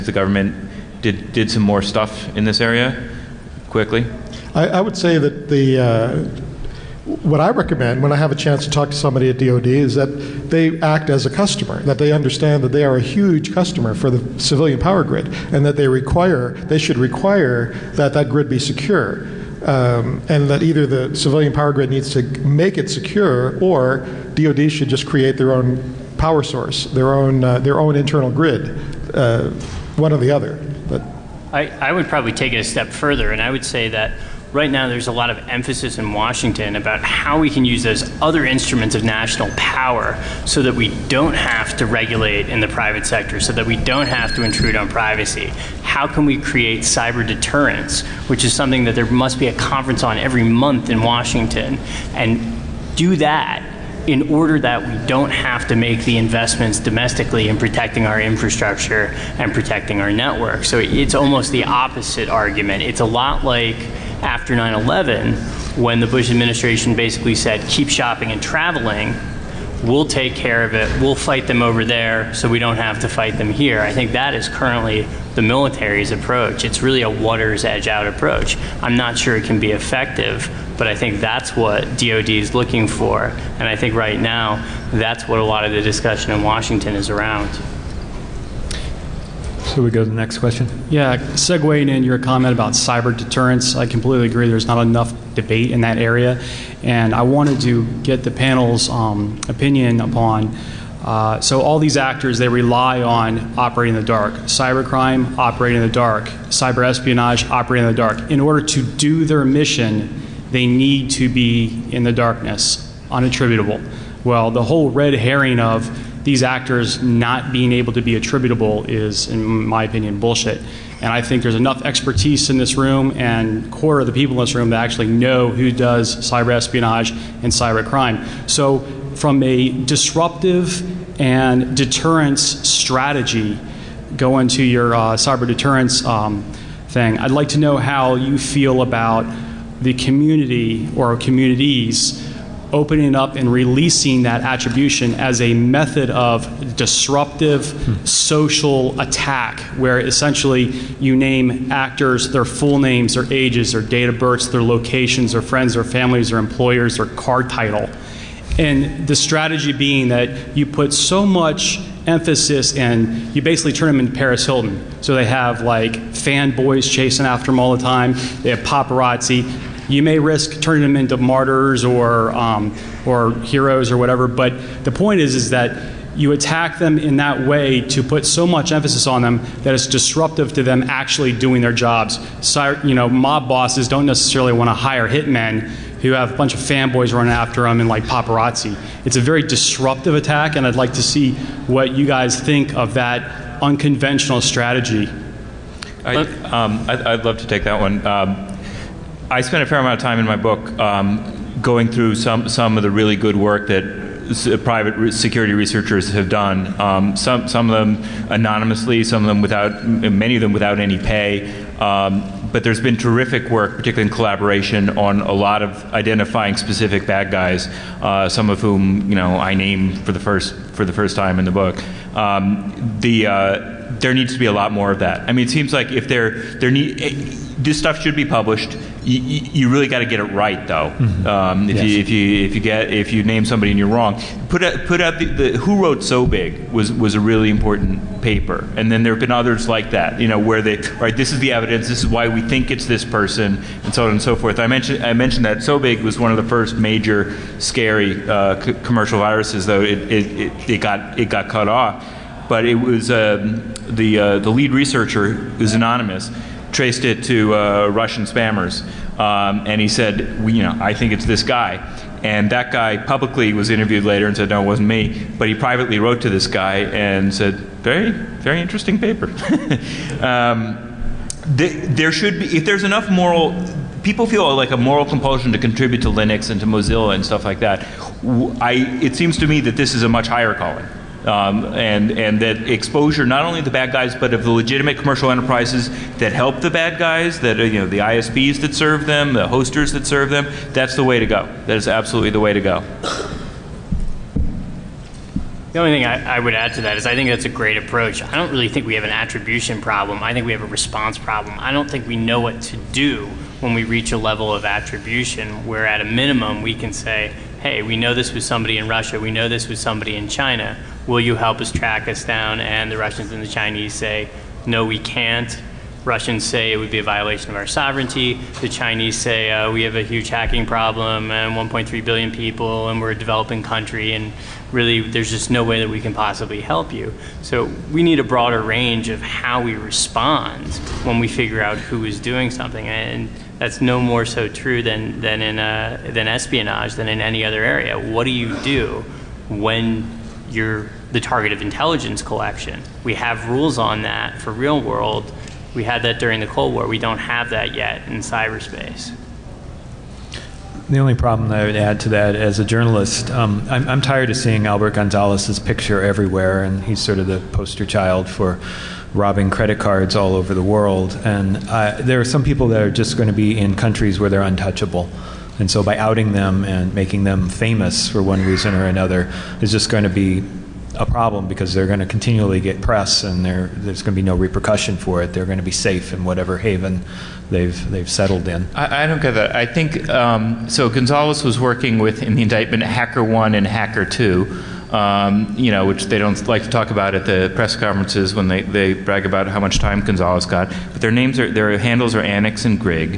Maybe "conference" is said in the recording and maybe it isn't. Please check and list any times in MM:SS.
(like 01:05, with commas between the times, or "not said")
00:49, 06:27.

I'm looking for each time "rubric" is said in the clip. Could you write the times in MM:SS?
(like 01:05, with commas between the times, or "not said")
not said.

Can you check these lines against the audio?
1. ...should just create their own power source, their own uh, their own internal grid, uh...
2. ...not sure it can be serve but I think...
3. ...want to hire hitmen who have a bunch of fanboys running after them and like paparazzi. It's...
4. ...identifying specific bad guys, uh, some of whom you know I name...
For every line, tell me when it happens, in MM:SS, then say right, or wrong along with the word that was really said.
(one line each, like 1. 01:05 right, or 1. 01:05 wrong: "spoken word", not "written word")
1. 00:24 right
2. 01:18 wrong: "effective", not "serve"
3. 03:04 right
4. 03:35 right.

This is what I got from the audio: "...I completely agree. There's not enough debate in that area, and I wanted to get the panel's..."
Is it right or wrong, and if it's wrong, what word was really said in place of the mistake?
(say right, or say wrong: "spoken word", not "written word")
right.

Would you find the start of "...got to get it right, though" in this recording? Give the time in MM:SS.
03:49.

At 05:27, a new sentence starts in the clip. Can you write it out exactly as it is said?
So we need a broader range of how we respond when we figure out who is doing something.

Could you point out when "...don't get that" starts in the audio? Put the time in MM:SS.
06:19.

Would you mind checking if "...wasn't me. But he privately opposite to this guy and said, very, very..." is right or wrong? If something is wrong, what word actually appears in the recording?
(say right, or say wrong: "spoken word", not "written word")
wrong: "wrote", not "opposite".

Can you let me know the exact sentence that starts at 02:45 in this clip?
So they have like fanboys chasing after them all the time.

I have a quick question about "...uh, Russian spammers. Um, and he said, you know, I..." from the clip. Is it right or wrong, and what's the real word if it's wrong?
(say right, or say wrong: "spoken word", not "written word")
right.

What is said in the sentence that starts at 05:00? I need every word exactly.
I think we have a response problem.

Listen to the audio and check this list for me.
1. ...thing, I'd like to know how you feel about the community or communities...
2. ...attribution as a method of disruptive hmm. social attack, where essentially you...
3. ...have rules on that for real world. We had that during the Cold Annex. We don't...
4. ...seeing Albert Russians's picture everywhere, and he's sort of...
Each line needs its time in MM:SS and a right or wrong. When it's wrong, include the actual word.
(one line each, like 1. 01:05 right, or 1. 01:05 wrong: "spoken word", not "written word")
1. 02:16 right
2. 02:24 right
3. 05:43 wrong: "War", not "Annex"
4. 05:54 wrong: "Gonzalez", not "Russians".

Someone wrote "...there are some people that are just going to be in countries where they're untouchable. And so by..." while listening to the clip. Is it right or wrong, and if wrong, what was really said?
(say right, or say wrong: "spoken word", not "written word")
right.